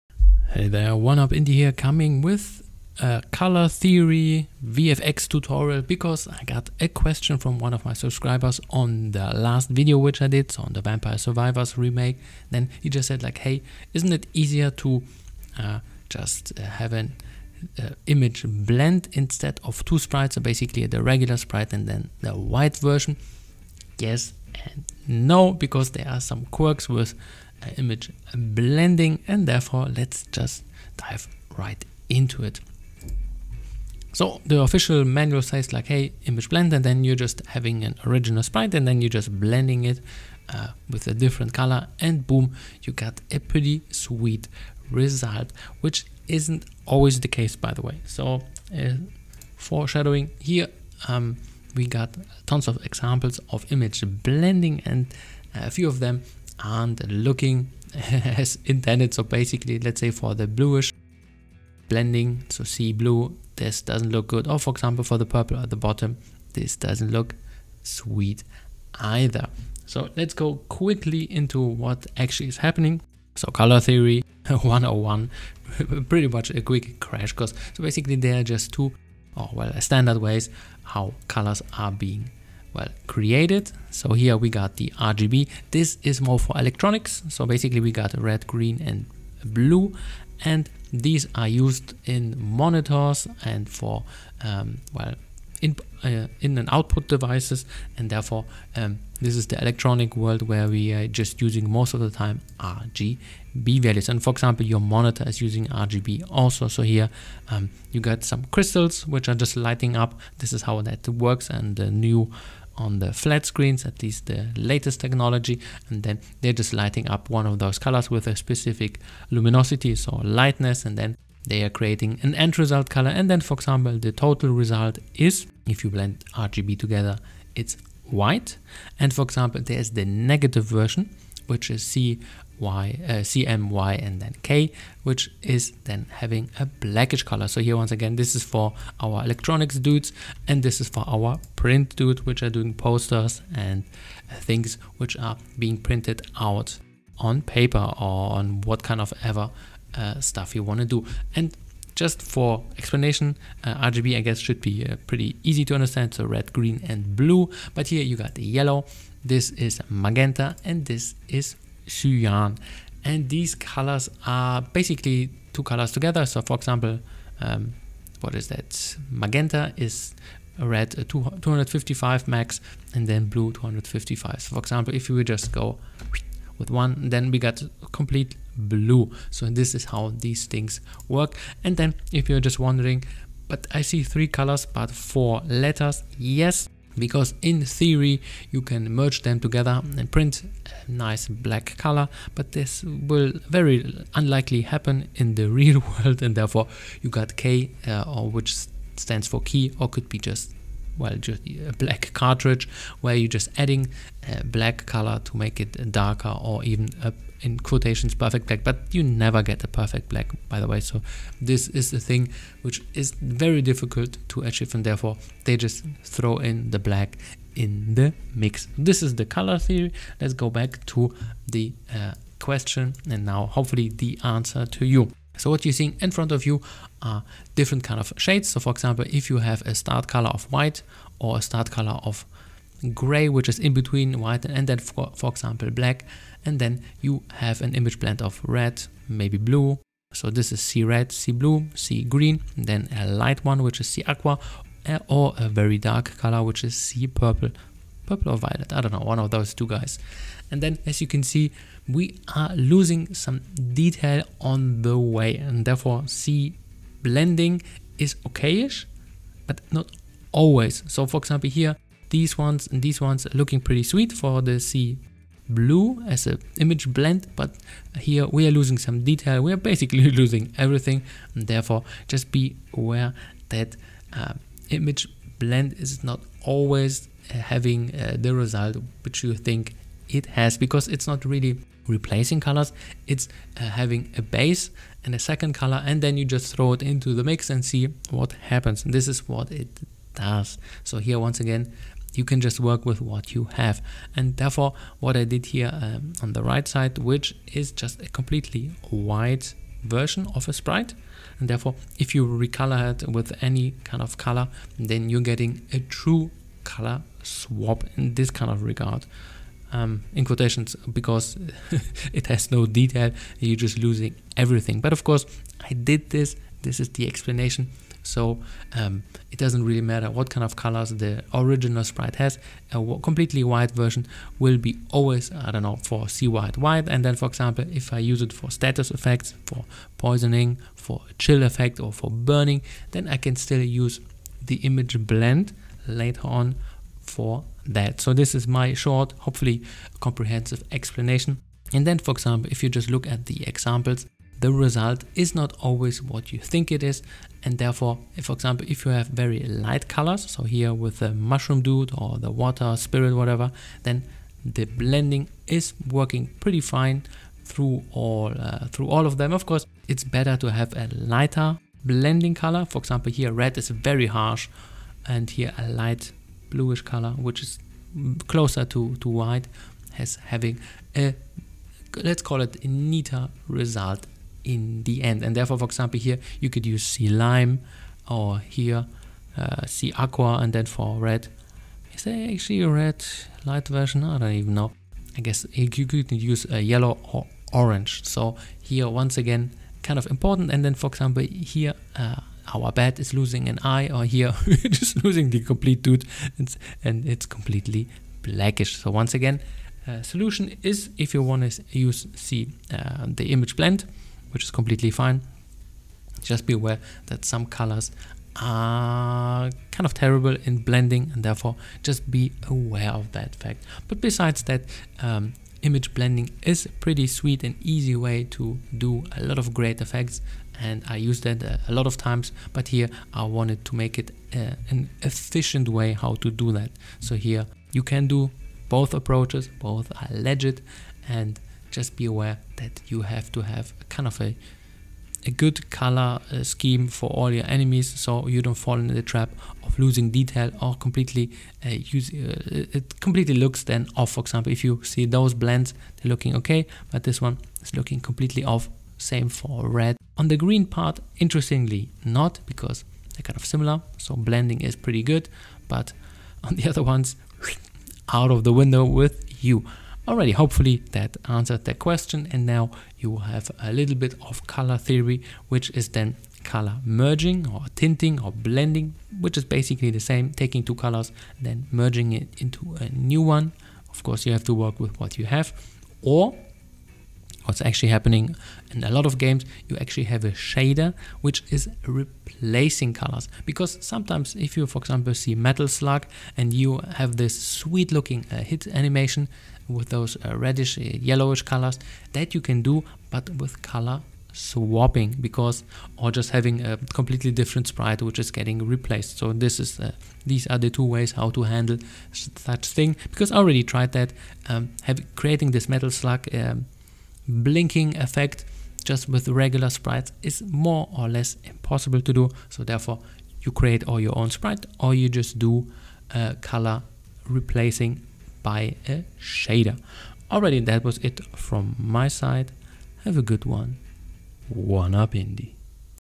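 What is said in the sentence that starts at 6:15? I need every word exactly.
And therefore, for example, here you could use C lime or here uh, aqua and then for red.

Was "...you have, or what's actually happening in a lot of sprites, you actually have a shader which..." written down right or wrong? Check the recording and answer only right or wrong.
wrong.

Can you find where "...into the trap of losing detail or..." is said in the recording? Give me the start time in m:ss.
7:18.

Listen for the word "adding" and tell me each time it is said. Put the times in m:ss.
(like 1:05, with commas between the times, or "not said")
3:23.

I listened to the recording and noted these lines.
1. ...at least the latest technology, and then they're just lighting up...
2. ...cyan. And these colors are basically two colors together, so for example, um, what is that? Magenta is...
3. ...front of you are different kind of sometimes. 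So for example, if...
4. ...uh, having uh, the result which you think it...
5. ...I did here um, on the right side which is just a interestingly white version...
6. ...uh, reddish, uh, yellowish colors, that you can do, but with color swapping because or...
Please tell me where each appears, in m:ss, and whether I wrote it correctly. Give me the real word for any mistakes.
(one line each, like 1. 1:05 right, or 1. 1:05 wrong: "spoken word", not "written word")
1. 1:53 right
2. 2:41 right
3. 3:46 wrong: "shades", not "sometimes"
4. 4:37 right
5. 4:55 wrong: "completely", not "interestingly"
6. 8:10 right.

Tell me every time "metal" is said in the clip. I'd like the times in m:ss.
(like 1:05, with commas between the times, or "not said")
8:05, 8:25.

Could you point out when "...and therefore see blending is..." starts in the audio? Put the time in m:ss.
4:15.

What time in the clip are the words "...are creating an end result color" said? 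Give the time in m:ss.
2:01.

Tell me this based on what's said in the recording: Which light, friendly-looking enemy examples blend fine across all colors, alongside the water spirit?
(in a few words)
The mushroom dude.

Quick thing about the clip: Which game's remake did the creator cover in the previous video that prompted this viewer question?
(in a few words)
Vampire Survivors.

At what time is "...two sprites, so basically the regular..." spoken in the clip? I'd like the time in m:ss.
0:19.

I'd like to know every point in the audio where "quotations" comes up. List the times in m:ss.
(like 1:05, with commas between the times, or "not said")
3:27, 5:10.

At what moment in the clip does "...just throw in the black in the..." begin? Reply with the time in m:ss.
3:35.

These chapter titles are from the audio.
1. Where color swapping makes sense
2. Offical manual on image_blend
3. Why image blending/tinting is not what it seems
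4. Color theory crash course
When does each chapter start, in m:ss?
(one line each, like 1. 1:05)
1. 8:02
2. 0:38
3. 3:42
4. 1:10.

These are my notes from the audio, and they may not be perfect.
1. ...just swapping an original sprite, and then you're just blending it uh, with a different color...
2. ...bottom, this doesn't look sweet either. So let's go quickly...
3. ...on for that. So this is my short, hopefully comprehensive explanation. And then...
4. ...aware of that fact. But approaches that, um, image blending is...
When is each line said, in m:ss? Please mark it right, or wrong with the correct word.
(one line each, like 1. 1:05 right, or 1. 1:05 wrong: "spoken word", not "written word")
1. 0:37 wrong: "having", not "swapping"
2. 1:05 right
3. 5:36 right
4. 6:52 wrong: "besides", not "approaches".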